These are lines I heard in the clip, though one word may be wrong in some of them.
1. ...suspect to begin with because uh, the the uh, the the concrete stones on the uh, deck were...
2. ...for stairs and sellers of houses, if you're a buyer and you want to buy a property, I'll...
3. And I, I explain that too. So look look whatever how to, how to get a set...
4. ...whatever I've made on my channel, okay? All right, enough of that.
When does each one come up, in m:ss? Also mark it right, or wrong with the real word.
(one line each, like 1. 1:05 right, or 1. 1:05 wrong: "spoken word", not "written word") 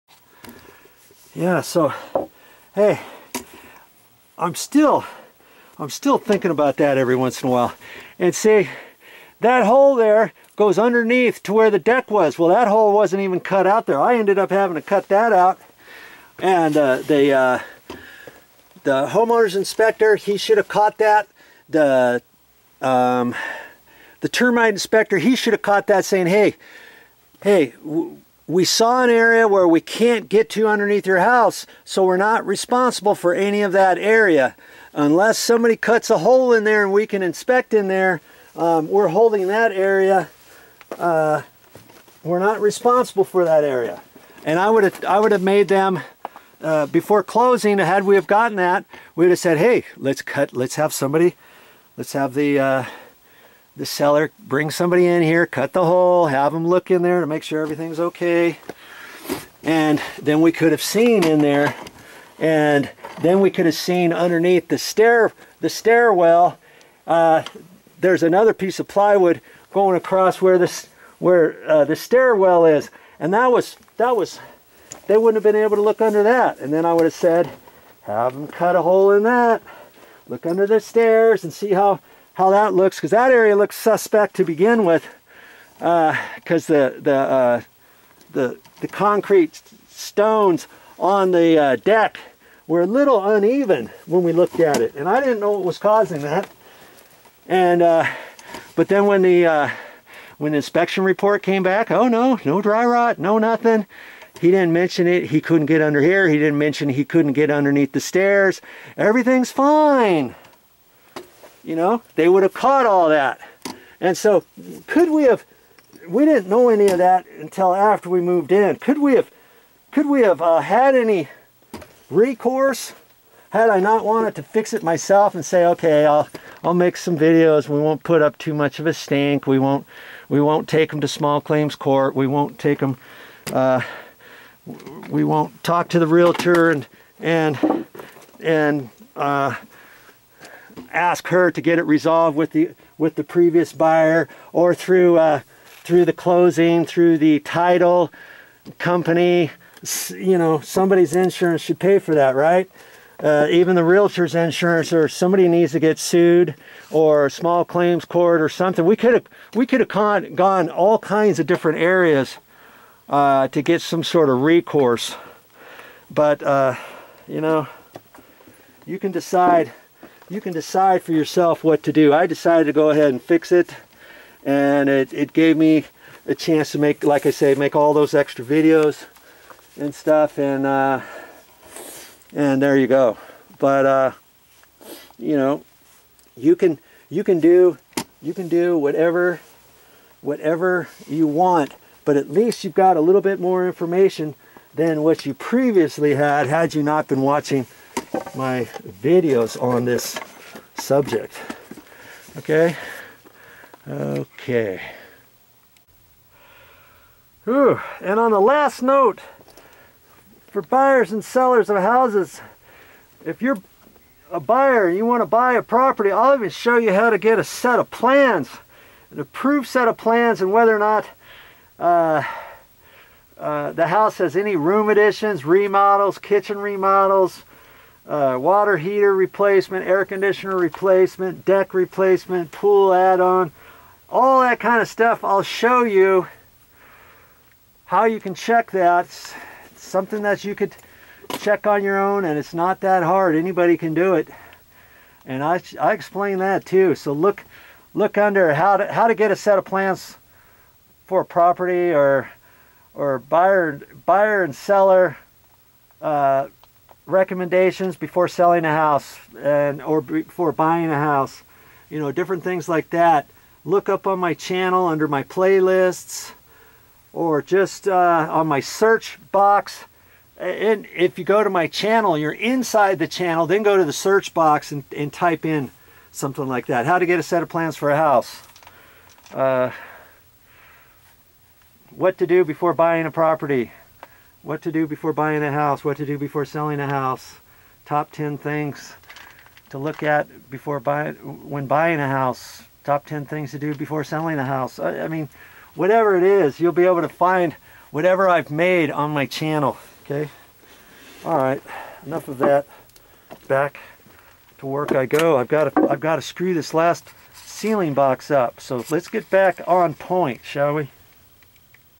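1. 1:23 right
2. 3:30 wrong: "buyers", not "stairs"
3. 4:05 wrong: "under", not "whatever"
4. 4:57 right.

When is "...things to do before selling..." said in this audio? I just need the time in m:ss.
4:53.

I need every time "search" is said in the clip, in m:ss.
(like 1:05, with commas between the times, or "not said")
4:28, 4:33.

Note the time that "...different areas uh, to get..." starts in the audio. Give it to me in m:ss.
2:41.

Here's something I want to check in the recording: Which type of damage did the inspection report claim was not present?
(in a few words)
Dry rot.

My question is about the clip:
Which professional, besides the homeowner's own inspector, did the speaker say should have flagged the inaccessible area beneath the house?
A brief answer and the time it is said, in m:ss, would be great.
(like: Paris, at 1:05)
Termite inspector, at 0:24.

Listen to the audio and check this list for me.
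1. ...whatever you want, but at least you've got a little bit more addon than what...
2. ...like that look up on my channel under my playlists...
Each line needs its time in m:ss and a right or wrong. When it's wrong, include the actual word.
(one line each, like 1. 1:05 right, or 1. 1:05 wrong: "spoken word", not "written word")
1. 3:10 wrong: "information", not "addon"
2. 4:22 right.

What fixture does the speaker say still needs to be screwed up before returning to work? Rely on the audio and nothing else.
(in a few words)
Last ceiling box.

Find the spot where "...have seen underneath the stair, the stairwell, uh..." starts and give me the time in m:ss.
1:03.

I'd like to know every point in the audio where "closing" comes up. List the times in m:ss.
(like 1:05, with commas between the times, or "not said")
0:47, 2:26.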